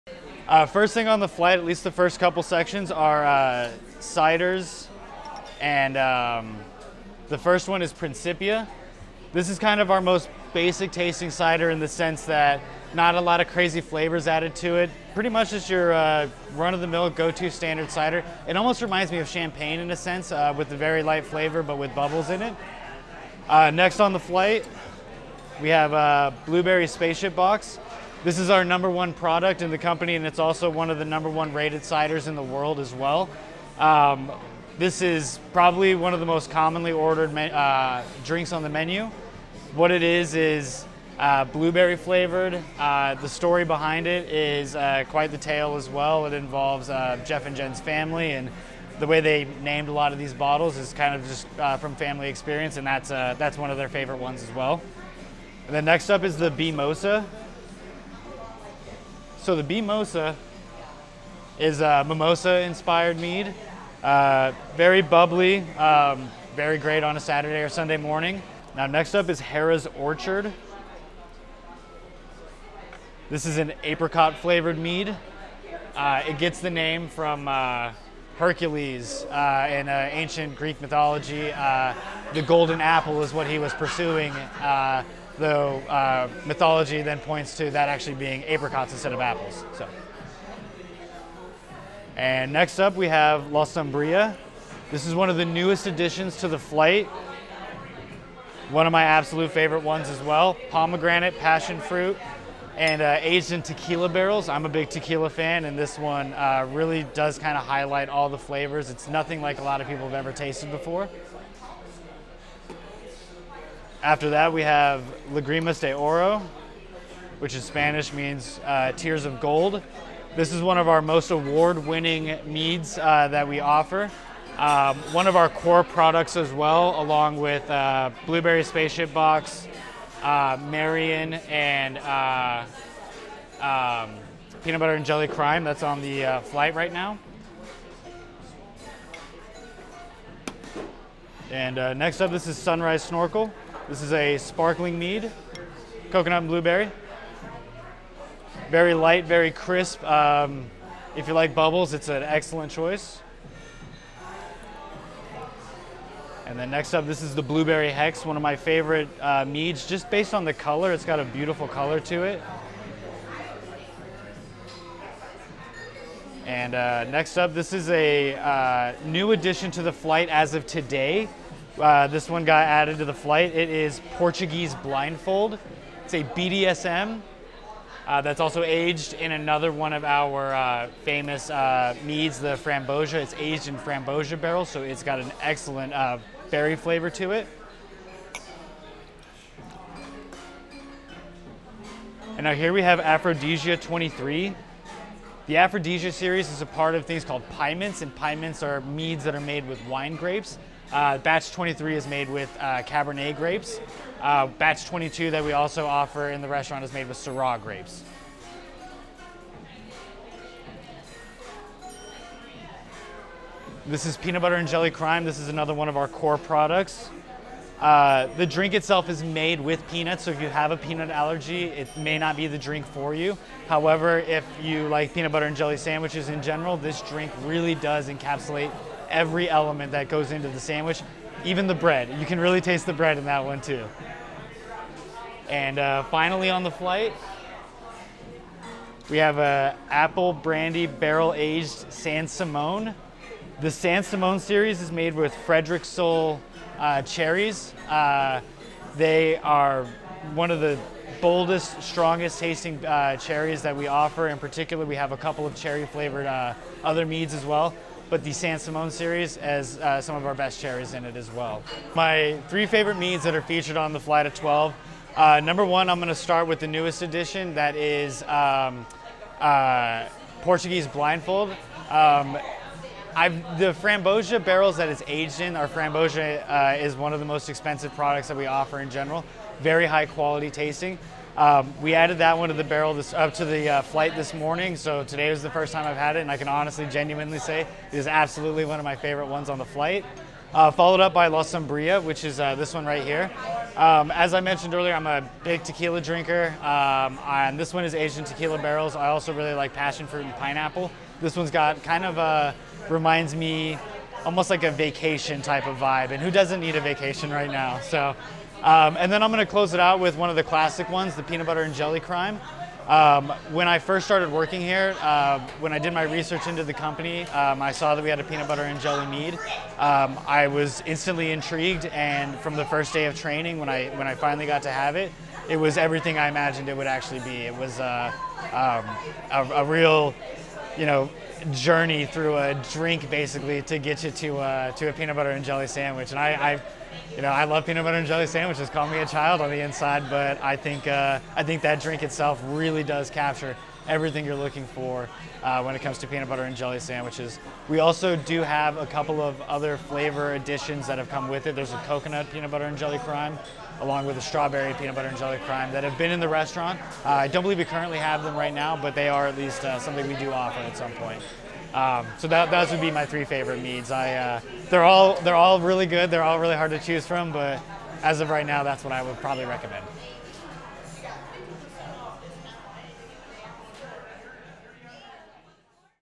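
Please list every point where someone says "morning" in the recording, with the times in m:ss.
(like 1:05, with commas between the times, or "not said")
1:07, 4:44.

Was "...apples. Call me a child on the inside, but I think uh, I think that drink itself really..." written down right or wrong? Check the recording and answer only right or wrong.
wrong.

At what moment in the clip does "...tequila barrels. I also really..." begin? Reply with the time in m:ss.
4:58.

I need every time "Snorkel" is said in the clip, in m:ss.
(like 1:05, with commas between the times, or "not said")
2:23.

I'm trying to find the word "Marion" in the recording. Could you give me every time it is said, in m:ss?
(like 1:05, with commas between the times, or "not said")
2:10.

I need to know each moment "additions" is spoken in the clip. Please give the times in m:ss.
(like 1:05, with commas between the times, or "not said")
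1:35, 2:49, 5:50.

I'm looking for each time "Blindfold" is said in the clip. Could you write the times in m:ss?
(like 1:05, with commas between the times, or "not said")
2:54, 4:30.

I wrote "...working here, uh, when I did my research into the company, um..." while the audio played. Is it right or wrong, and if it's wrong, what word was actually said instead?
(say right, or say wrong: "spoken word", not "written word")
right.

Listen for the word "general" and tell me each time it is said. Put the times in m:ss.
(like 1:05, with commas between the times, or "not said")
3:46, 4:38.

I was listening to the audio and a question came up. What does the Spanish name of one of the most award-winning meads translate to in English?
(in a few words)
Tears of gold.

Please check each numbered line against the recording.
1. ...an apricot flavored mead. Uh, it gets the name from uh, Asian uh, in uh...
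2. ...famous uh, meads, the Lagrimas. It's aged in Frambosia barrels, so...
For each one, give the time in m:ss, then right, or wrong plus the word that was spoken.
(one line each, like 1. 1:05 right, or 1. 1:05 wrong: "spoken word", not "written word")
1. 1:13 wrong: "Hercules", not "Asian"
2. 3:01 wrong: "Frambosia", not "Lagrimas".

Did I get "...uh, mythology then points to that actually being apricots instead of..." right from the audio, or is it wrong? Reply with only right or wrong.
right.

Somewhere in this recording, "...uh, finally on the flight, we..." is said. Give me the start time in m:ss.
3:55.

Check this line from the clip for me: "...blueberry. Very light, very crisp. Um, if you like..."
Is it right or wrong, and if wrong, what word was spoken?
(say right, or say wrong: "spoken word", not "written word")
right.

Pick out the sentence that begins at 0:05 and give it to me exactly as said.
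And um, the first one is Principia.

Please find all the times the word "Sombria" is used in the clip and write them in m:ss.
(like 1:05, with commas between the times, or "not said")
1:33, 4:51.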